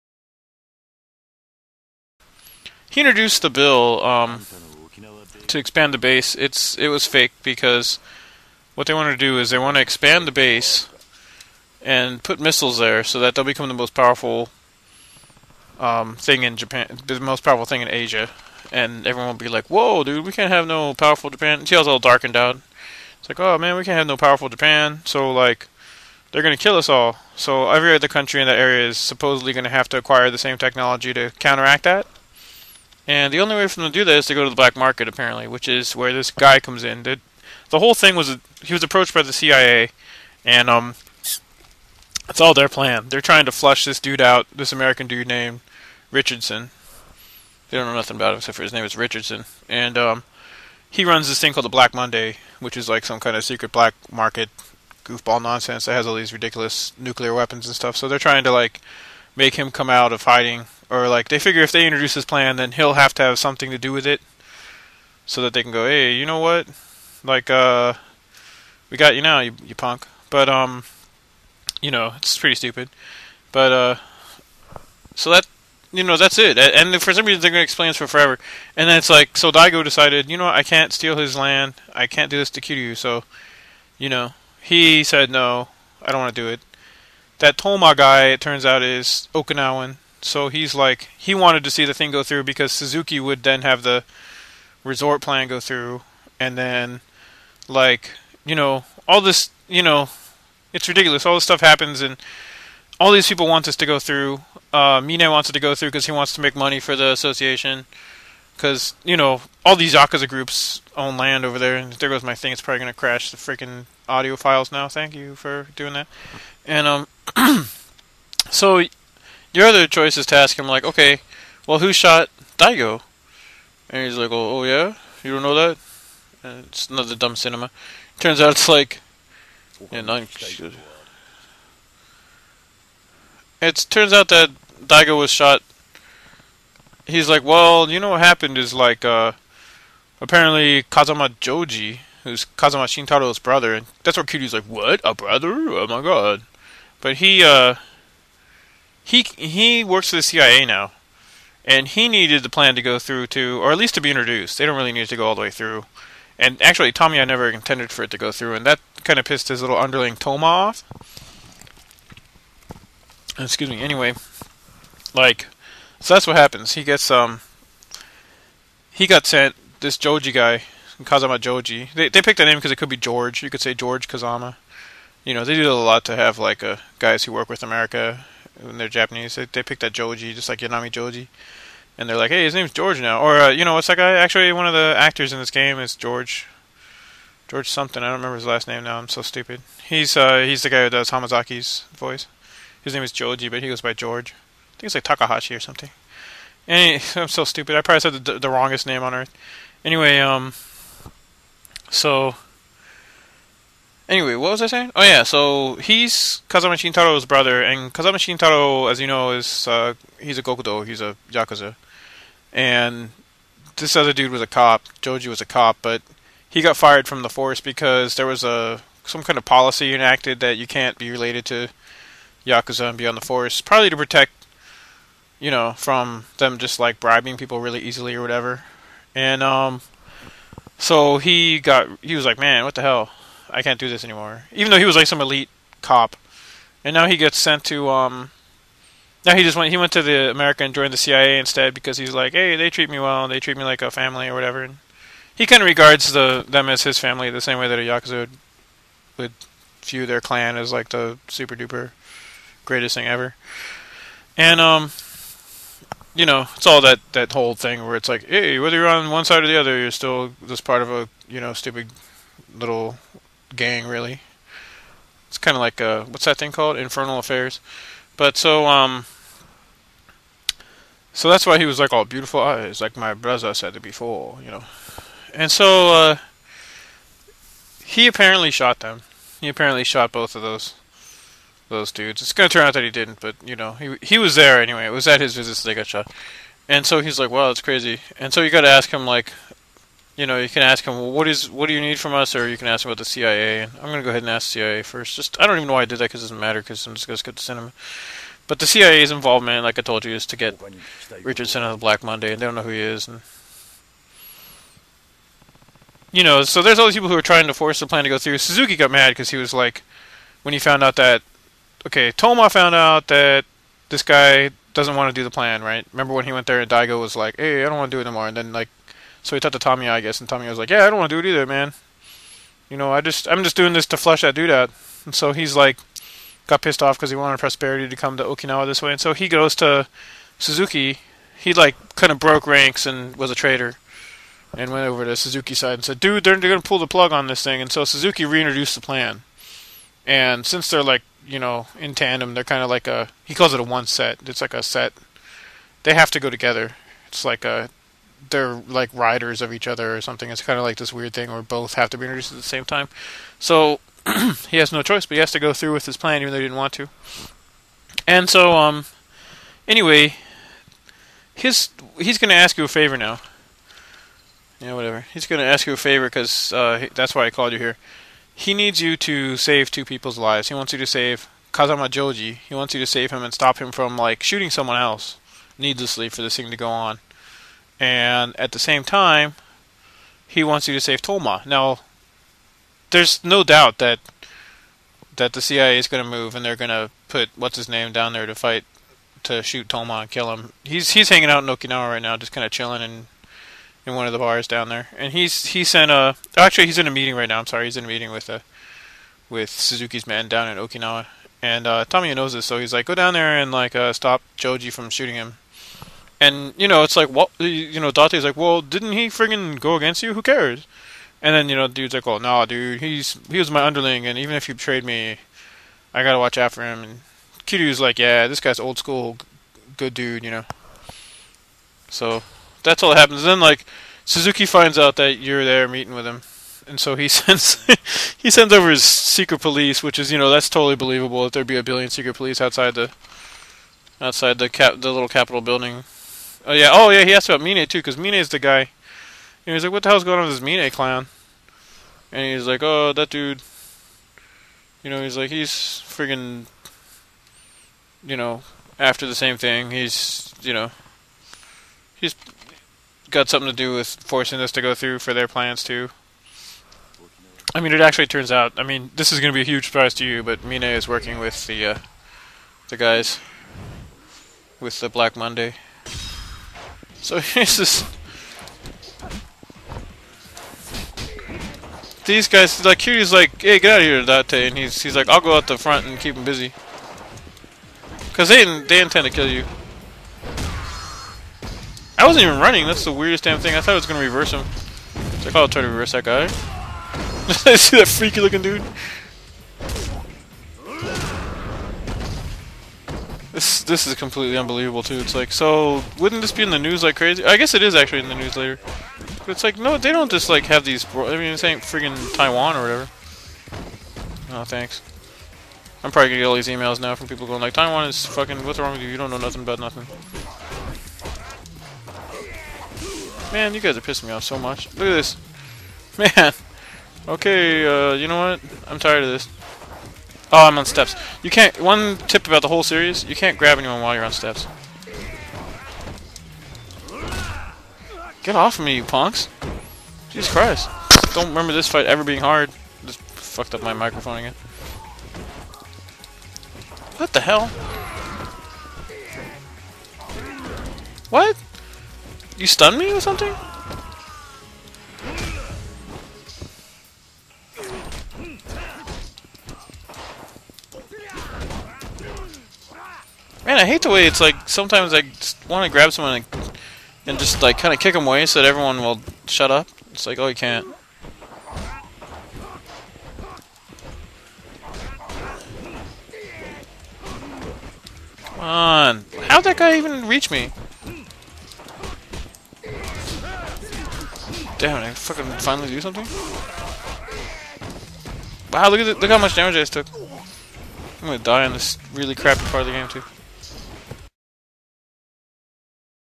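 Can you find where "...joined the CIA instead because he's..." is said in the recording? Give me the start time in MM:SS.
04:00.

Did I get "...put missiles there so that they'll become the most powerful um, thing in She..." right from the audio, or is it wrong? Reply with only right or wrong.
wrong.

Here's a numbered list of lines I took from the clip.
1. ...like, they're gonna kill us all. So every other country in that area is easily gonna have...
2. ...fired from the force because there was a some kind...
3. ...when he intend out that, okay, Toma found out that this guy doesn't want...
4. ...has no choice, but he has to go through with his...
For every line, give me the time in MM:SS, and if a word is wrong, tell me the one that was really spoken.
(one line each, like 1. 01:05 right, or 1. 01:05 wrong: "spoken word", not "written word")
1. 00:25 wrong: "supposedly", not "easily"
2. 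03:36 right
3. 05:10 wrong: "found", not "intend"
4. 05:54 right.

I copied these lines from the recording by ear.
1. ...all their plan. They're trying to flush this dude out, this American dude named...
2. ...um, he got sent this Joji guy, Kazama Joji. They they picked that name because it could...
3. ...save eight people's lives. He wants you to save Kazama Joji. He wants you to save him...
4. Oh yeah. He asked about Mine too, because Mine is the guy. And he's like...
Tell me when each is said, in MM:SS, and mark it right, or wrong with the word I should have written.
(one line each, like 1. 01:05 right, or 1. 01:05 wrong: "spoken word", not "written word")
1. 00:42 right
2. 02:47 right
3. 06:09 wrong: "two", not "eight"
4. 07:16 right.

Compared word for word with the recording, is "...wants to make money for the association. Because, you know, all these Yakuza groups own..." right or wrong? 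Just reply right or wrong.
right.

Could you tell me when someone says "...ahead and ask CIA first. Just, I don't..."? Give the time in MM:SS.
04:54.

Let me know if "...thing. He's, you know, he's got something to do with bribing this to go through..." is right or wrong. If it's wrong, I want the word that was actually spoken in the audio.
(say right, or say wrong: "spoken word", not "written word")
wrong: "forcing", not "bribing".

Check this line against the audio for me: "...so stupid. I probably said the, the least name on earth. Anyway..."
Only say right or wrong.
wrong.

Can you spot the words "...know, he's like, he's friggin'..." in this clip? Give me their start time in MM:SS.
07:24.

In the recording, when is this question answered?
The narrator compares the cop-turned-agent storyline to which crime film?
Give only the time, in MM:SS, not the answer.
04:26.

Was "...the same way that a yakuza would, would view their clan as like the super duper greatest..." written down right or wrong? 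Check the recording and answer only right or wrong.
right.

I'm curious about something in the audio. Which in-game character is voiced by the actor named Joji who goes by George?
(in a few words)
Hamazaki.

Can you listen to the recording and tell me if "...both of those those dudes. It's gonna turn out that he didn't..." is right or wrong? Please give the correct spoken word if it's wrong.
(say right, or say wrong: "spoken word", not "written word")
right.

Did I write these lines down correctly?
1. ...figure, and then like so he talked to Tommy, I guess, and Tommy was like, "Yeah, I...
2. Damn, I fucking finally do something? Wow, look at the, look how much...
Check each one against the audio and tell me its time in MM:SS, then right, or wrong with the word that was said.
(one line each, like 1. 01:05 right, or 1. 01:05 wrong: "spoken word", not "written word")
1. 05:18 wrong: "anymore", not "figure"
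2. 09:34 right.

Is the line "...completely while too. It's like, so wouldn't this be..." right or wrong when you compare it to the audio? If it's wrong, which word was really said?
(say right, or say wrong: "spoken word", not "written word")
wrong: "unbelievable", not "while".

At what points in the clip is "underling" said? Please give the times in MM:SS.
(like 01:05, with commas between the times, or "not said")
02:39, 06:53.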